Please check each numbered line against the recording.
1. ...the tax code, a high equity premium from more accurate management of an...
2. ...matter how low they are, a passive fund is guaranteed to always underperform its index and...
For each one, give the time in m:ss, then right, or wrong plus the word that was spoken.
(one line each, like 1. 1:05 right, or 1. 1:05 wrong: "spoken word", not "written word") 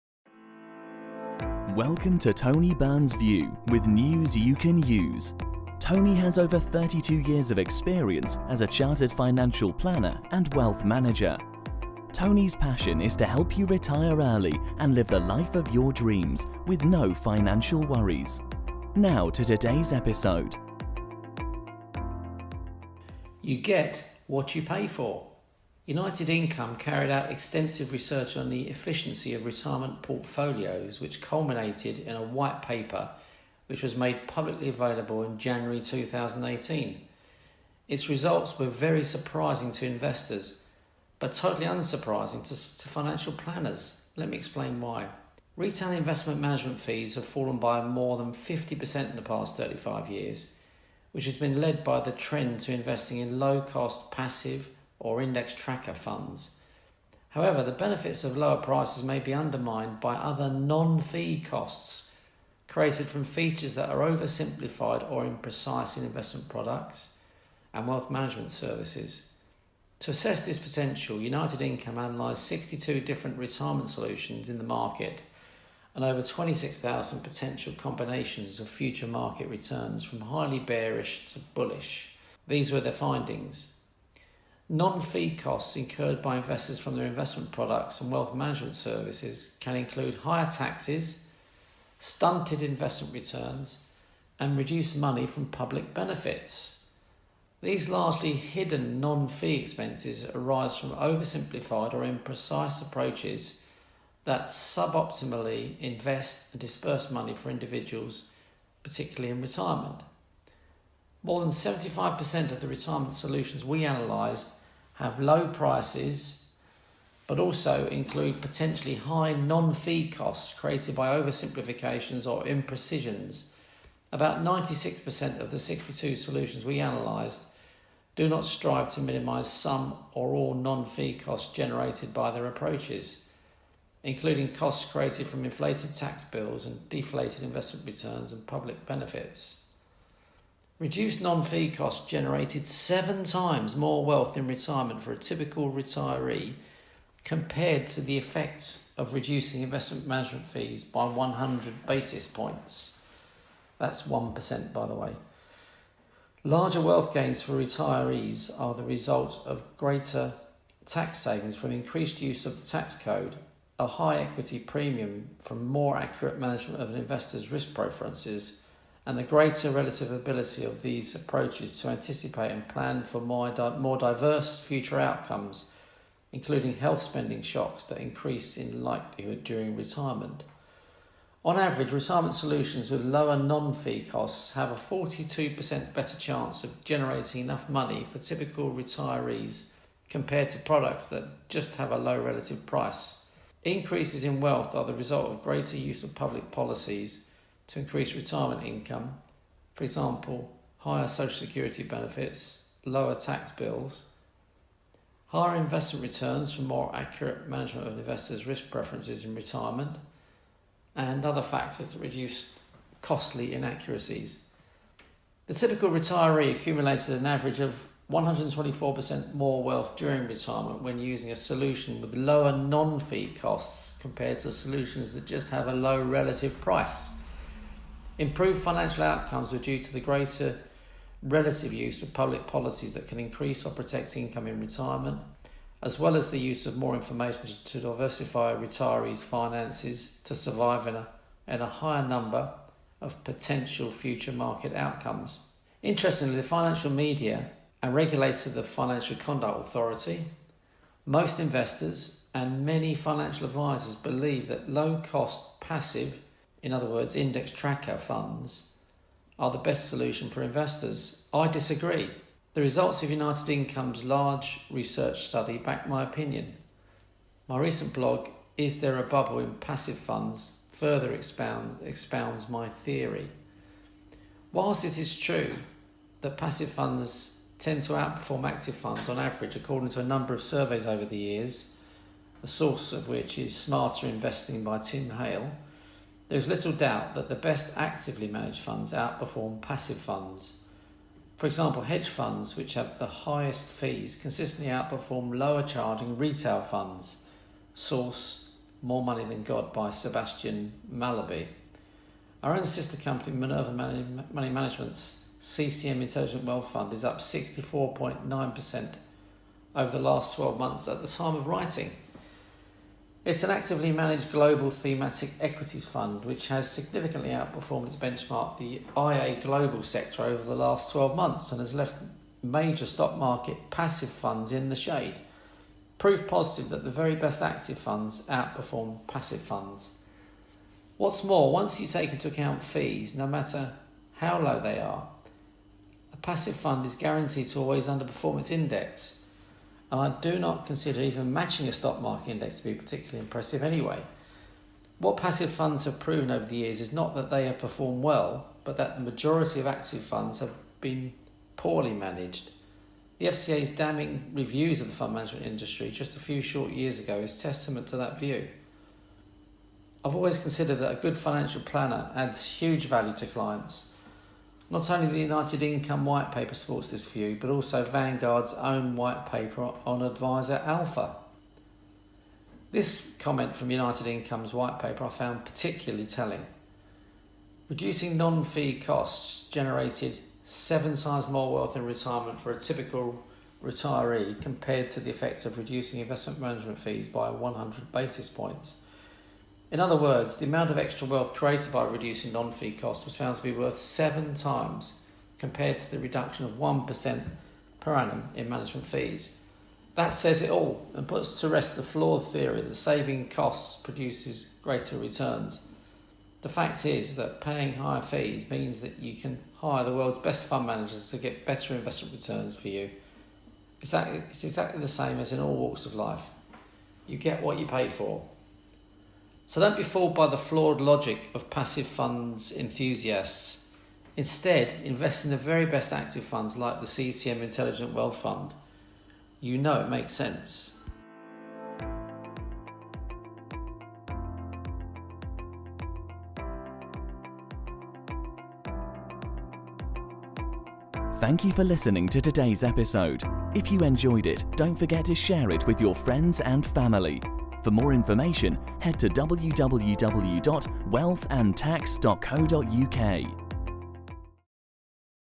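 1. 2:42 right
2. 5:33 right.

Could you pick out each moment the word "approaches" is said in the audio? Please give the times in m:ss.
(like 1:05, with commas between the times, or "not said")
1:42, 2:12, 2:51.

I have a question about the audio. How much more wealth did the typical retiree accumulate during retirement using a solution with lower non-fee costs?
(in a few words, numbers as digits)
124%.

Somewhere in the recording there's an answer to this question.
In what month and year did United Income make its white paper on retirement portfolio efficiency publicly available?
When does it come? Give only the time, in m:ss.
0:35.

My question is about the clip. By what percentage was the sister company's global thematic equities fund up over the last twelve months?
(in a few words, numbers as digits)
64.9%.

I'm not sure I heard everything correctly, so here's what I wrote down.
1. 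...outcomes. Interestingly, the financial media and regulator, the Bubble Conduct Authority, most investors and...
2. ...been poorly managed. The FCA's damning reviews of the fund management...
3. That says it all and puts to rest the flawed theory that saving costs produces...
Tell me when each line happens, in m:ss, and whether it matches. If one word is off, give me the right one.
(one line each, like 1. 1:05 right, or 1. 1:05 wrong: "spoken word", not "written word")
1. 4:04 wrong: "Financial", not "Bubble"
2. 5:50 right
3. 6:39 right.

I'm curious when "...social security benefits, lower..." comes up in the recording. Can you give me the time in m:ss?
3:21.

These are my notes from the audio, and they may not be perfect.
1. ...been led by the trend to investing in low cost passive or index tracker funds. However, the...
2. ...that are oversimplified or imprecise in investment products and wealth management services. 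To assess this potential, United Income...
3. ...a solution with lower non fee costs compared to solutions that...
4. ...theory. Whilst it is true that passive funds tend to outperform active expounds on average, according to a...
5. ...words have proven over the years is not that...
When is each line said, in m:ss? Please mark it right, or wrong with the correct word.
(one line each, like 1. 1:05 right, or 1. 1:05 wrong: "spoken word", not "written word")
1. 0:51 right
2. 1:03 right
3. 3:41 right
4. 4:32 wrong: "funds", not "expounds"
5. 5:45 wrong: "funds", not "words".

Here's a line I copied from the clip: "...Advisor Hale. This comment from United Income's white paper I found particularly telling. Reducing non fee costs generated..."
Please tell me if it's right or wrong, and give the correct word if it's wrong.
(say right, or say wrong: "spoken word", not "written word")
wrong: "Alpha", not "Hale".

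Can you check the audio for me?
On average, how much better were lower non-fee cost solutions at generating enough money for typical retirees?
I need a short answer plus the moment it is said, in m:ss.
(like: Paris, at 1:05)
42%, at 3:04.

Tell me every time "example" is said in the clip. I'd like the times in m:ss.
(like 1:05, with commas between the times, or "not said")
3:19, 4:51.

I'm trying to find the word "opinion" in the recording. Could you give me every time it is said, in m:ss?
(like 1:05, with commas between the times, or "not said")
4:26.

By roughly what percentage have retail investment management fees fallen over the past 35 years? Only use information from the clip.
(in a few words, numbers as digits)
more than 50%.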